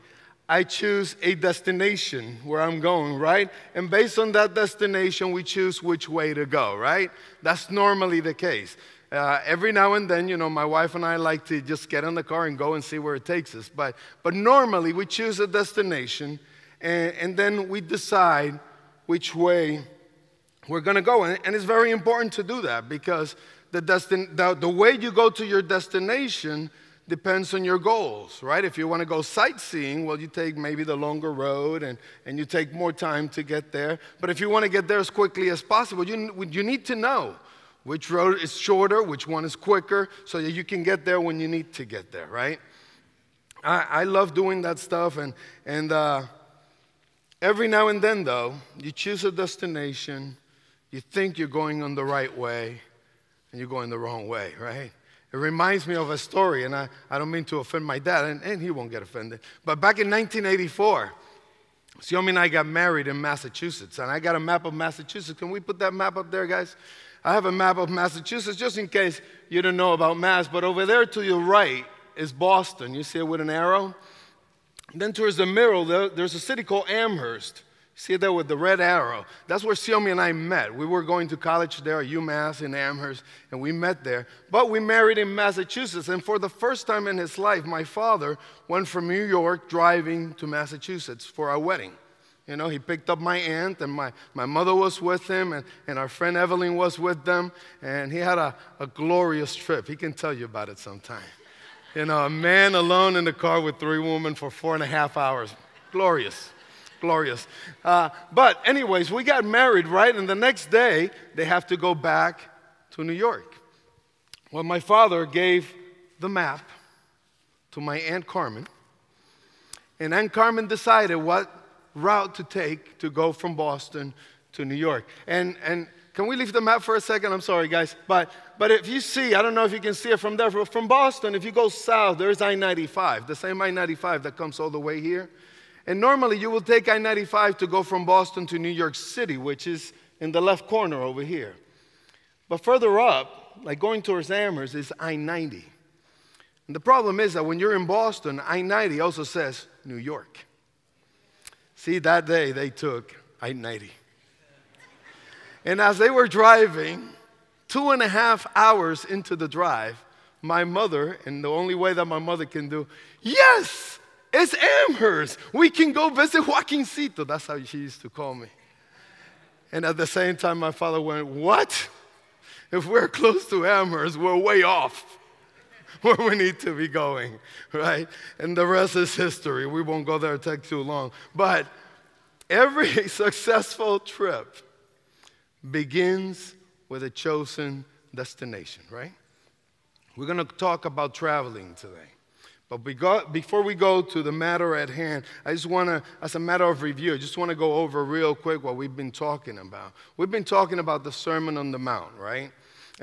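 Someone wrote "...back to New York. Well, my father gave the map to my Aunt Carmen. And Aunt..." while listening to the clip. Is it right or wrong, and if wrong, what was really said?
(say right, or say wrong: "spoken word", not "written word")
right.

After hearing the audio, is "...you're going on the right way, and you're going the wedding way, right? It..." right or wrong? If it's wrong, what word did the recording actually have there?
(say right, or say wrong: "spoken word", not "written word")
wrong: "wrong", not "wedding".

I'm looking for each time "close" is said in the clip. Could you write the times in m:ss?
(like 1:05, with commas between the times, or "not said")
2:53.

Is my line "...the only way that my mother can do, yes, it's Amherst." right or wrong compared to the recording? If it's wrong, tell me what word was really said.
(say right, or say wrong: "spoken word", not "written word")
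right.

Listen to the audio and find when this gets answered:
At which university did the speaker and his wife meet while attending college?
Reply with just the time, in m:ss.
1:22.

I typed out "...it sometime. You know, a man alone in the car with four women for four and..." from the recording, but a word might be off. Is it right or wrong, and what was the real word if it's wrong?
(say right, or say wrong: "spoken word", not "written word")
wrong: "three", not "four".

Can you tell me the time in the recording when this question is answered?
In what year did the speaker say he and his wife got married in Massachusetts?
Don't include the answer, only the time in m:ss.
1:00.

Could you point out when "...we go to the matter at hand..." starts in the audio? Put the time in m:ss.
3:13.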